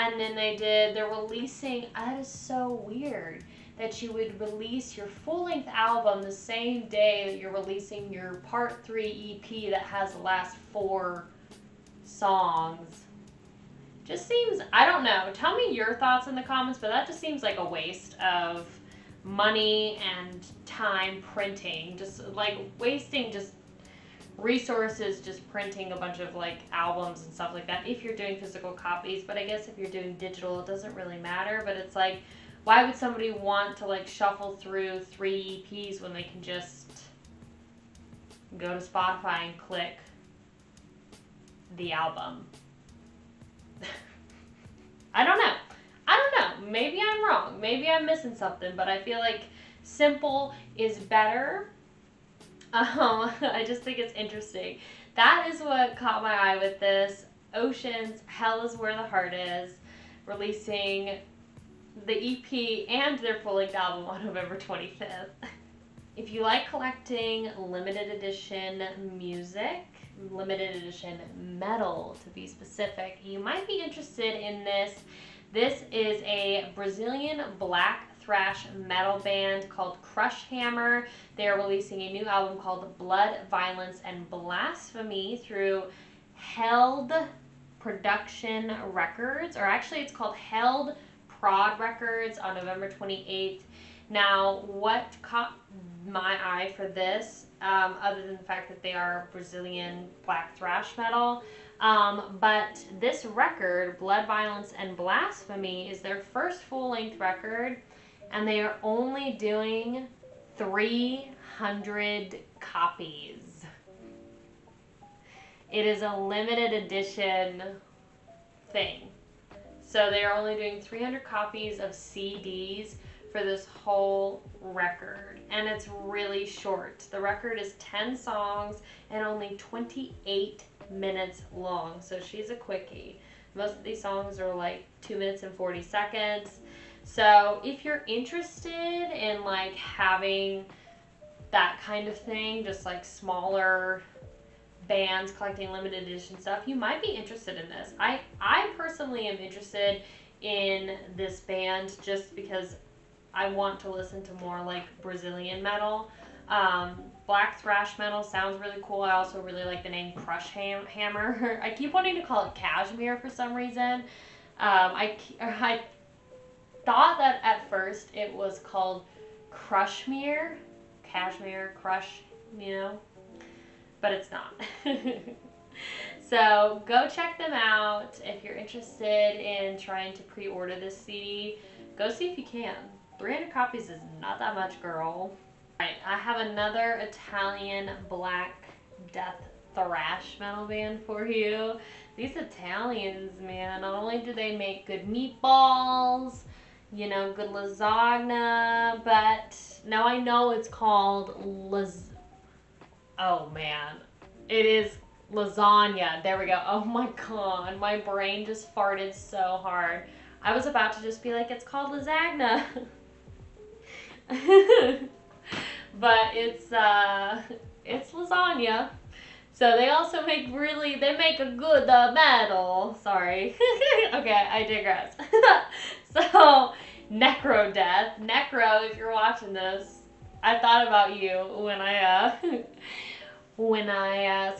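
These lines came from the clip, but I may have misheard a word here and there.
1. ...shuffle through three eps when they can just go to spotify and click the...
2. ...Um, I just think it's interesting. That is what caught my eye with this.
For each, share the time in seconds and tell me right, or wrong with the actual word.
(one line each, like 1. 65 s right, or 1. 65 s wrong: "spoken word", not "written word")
1. 34 s right
2. 52 s right.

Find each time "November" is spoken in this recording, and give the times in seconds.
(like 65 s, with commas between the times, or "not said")
64 s, 92 s.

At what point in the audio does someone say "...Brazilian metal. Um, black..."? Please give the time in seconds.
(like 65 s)
155 s.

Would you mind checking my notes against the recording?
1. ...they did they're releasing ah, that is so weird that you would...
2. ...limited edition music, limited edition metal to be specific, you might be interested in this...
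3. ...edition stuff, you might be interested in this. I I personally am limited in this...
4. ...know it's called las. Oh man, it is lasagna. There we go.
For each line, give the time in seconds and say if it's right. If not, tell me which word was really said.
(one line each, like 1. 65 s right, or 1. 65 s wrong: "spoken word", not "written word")
1. 0 s right
2. 67 s right
3. 146 s wrong: "interested", not "limited"
4. 200 s right.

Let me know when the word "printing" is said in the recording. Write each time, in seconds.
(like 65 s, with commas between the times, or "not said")
21 s, 25 s.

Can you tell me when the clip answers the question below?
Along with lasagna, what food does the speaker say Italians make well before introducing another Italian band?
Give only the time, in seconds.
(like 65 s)
195 s.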